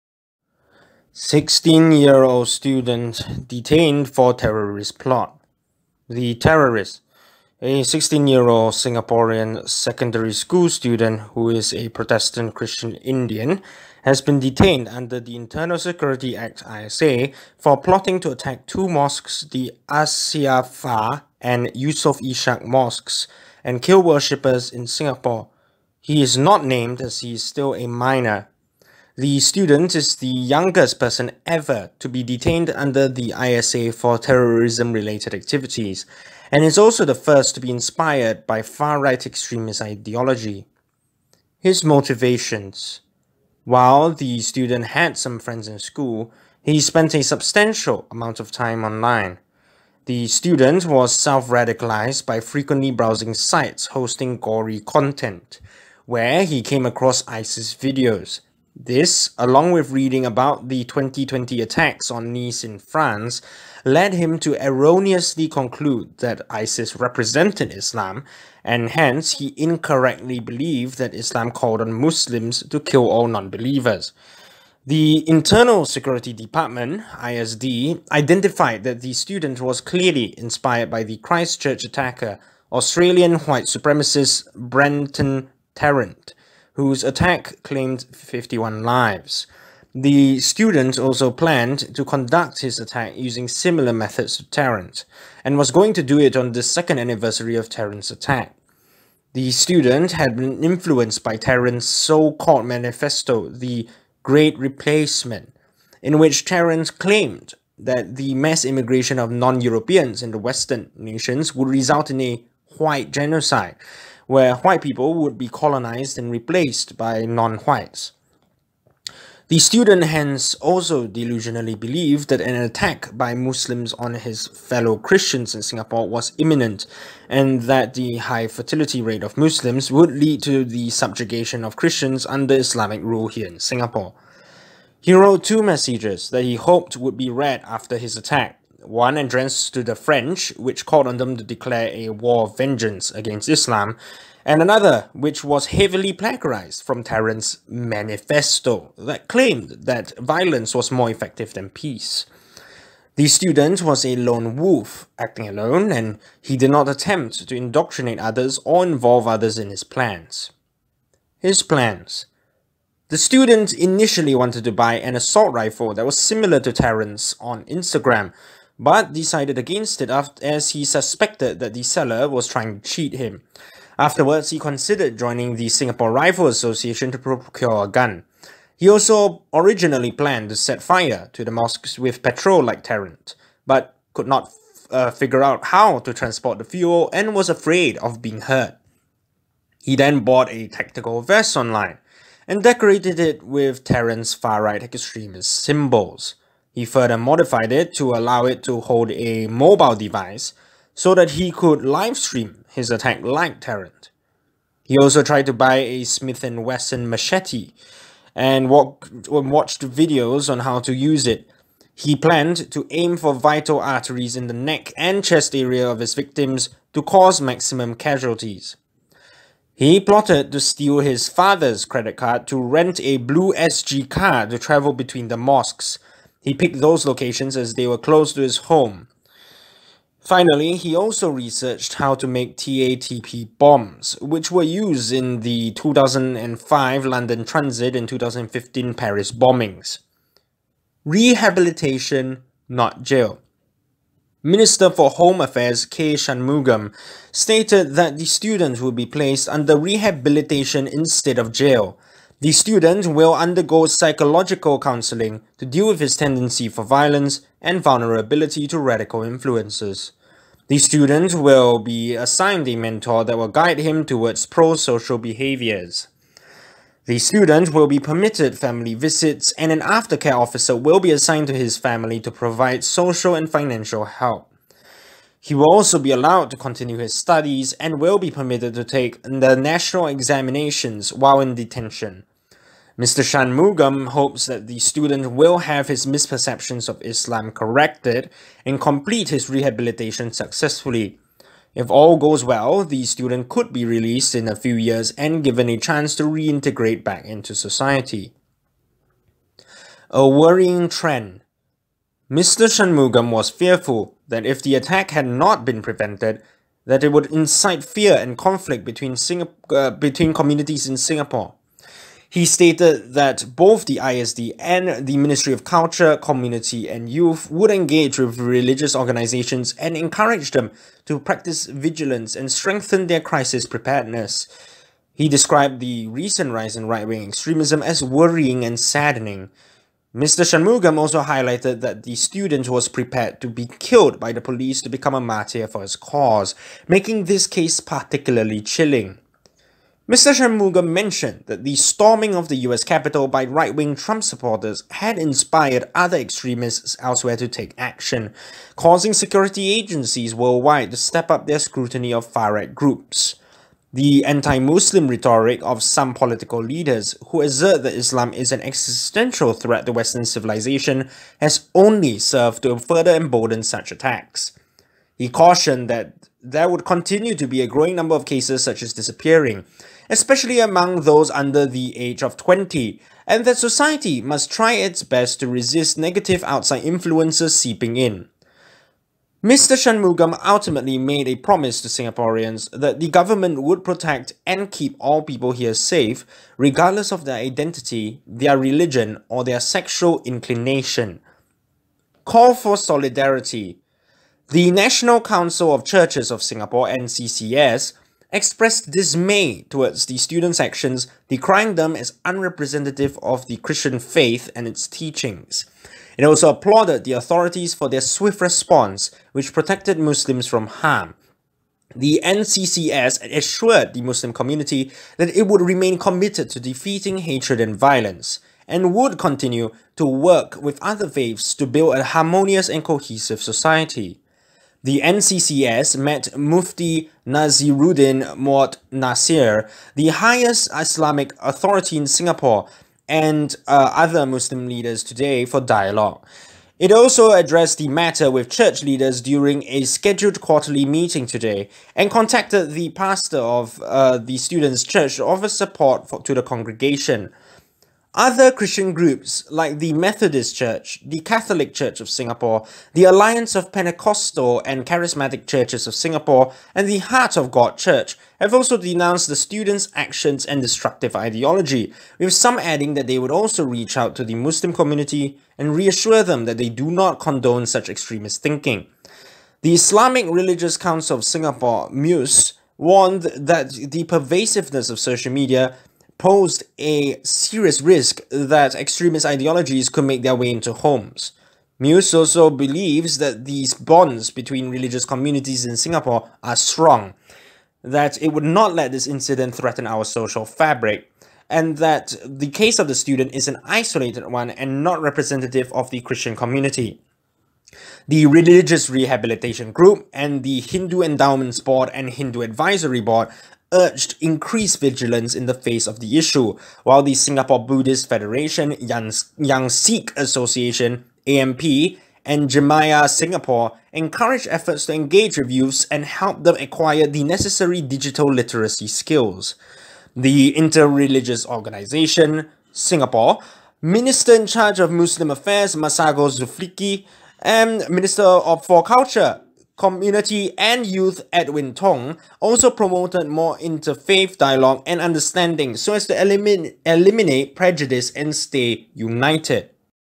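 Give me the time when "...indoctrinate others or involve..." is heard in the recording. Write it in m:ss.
2:37.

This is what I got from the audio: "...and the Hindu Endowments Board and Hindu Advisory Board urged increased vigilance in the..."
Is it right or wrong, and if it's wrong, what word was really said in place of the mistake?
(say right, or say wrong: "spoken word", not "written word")
right.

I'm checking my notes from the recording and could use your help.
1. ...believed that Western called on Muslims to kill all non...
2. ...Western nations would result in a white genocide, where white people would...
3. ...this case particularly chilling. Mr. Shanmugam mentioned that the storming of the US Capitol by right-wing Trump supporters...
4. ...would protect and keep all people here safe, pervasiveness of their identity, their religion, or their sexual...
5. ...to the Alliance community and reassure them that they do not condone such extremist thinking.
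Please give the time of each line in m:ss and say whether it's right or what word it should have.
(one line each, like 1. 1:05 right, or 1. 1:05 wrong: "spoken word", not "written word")
1. 1:10 wrong: "Islam", not "Western"
2. 1:50 right
3. 5:37 right
4. 6:23 wrong: "regardless", not "pervasiveness"
5. 7:44 wrong: "Muslim", not "Alliance".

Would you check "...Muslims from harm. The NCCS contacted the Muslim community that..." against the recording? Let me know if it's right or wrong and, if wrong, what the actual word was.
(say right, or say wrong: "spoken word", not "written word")
wrong: "assured", not "contacted".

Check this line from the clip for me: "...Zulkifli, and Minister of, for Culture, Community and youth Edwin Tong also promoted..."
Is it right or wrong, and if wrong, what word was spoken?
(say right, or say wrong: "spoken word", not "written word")
right.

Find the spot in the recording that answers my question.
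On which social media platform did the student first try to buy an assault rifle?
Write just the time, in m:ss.
2:47.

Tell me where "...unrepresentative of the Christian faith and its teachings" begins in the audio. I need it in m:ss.
6:42.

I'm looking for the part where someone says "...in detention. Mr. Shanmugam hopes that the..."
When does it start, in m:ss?
4:41.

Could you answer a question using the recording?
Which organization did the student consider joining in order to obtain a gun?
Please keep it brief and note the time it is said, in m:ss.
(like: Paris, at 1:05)
Singapore Rifle Association, at 2:55.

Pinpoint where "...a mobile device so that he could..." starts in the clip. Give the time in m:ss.
3:19.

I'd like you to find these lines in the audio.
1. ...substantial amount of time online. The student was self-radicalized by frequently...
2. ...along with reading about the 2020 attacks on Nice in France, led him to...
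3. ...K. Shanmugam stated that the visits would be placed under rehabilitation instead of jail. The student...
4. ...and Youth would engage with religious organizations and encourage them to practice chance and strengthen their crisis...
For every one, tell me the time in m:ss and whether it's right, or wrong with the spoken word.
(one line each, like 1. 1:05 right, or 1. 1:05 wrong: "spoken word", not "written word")
1. 0:47 right
2. 0:59 right
3. 4:05 wrong: "students", not "visits"
4. 5:16 wrong: "vigilance", not "chance".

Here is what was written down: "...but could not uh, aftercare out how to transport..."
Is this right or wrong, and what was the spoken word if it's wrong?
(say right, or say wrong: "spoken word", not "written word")
wrong: "figure", not "aftercare".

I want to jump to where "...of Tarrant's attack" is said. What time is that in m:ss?
1:37.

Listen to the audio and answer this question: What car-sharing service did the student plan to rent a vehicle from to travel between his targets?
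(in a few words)
BlueSG.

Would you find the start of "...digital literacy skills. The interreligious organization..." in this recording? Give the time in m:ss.
8:37.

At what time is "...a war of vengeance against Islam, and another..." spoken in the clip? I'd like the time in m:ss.
2:21.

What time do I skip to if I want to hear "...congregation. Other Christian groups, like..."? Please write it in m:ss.
7:26.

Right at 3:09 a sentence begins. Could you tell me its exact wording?
He then bought a tactical vest online and decorated it with Tarrant's far-right extremist symbols.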